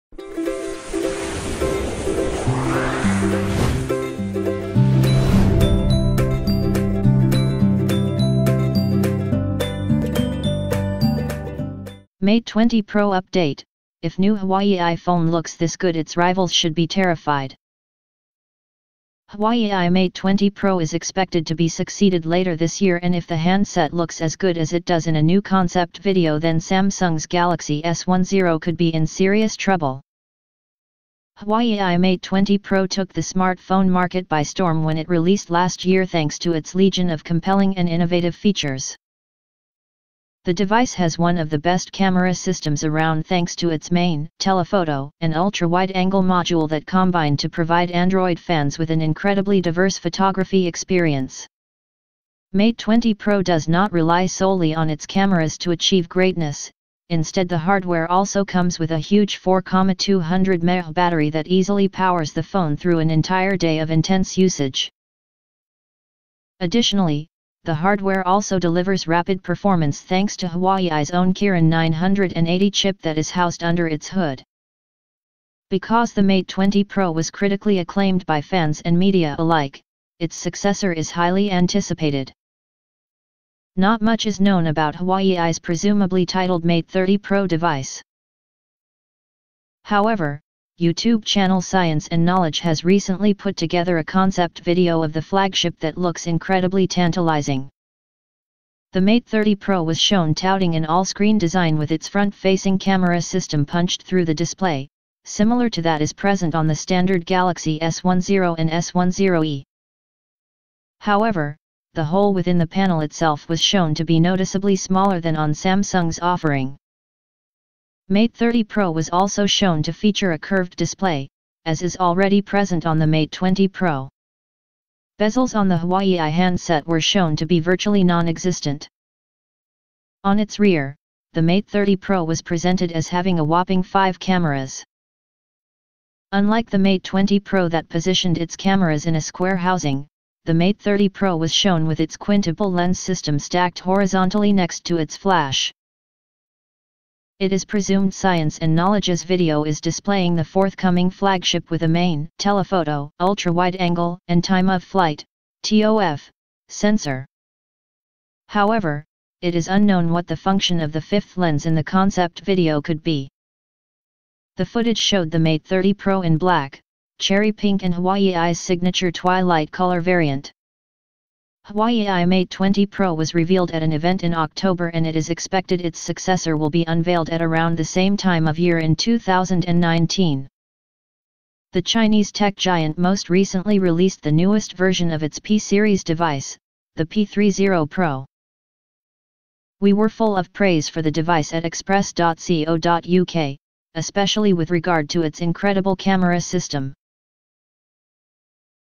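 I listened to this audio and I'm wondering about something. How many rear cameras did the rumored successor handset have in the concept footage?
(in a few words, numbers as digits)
5.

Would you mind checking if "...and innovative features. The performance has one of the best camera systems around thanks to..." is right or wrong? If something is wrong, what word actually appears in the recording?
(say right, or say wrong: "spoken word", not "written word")
wrong: "device", not "performance".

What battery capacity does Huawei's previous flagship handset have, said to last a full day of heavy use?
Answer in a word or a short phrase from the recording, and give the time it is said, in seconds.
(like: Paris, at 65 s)
4,200 mAh, at 59 s.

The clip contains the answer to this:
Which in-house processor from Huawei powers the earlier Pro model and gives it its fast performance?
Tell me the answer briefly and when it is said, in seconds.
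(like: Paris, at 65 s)
Kirin 980, at 71 s.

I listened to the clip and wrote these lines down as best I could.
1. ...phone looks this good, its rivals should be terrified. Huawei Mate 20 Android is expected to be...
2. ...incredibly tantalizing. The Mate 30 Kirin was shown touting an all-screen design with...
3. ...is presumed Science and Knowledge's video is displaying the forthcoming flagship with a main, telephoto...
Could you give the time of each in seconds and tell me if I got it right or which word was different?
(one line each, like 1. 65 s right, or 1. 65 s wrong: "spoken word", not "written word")
1. 14 s wrong: "Pro", not "Android"
2. 96 s wrong: "Pro", not "Kirin"
3. 147 s right.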